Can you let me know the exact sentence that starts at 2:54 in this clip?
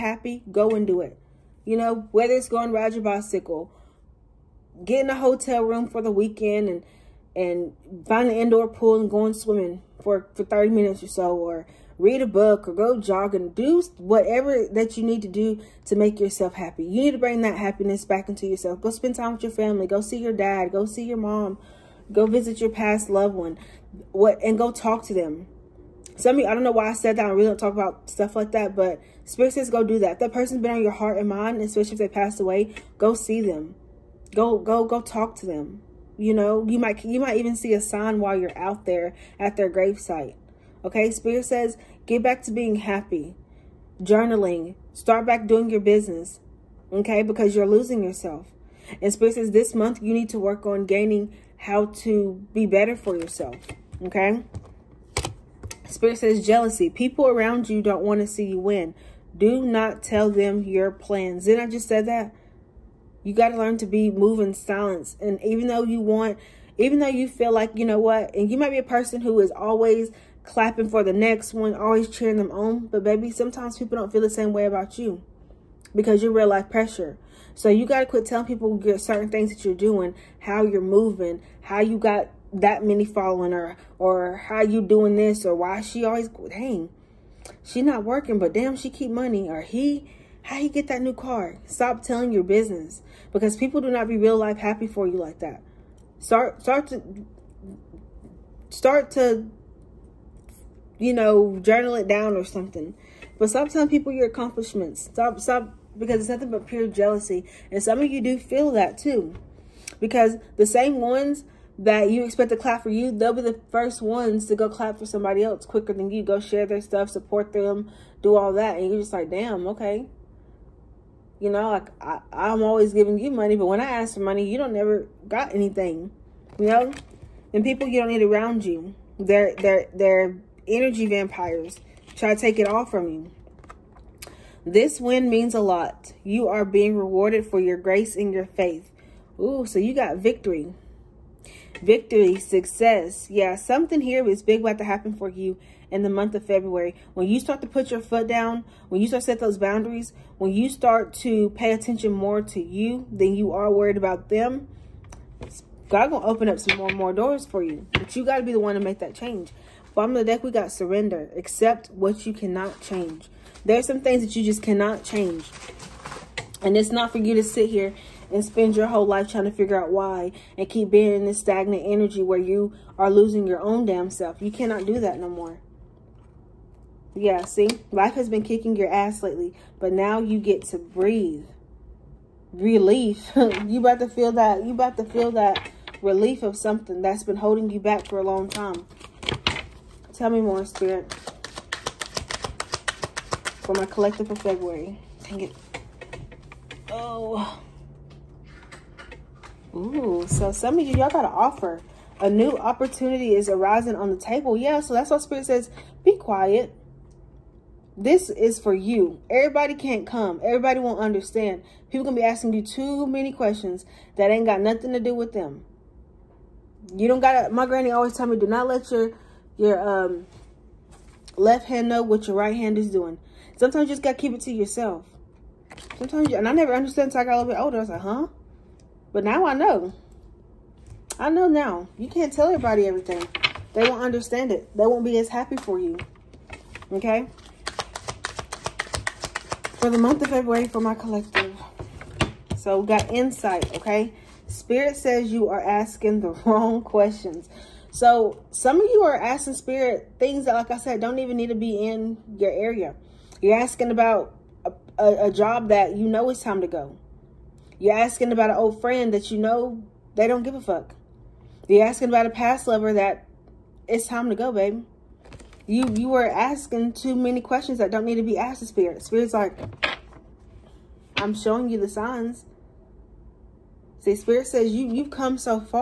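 You cannot do that no more.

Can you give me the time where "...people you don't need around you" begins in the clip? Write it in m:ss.
2:07.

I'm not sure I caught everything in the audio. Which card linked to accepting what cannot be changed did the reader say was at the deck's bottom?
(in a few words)
Surrender.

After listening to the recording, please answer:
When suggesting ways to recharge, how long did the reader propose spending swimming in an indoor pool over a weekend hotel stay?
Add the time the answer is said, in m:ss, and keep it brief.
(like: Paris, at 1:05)
30 minutes, at 0:10.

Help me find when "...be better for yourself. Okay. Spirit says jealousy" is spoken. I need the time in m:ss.
0:52.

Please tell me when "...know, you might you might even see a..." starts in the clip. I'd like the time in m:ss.
0:36.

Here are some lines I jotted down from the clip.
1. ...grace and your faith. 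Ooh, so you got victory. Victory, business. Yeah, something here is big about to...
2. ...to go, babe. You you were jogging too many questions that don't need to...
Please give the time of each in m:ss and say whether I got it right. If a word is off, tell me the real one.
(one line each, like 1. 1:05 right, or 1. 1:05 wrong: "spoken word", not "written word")
1. 2:17 wrong: "success", not "business"
2. 4:24 wrong: "asking", not "jogging".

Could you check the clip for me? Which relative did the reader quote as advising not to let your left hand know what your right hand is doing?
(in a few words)
Granny.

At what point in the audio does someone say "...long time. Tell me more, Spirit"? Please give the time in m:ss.
3:08.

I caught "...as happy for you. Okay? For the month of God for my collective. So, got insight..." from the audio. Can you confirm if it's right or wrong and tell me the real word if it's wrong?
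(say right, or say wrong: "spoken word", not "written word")
wrong: "February", not "God".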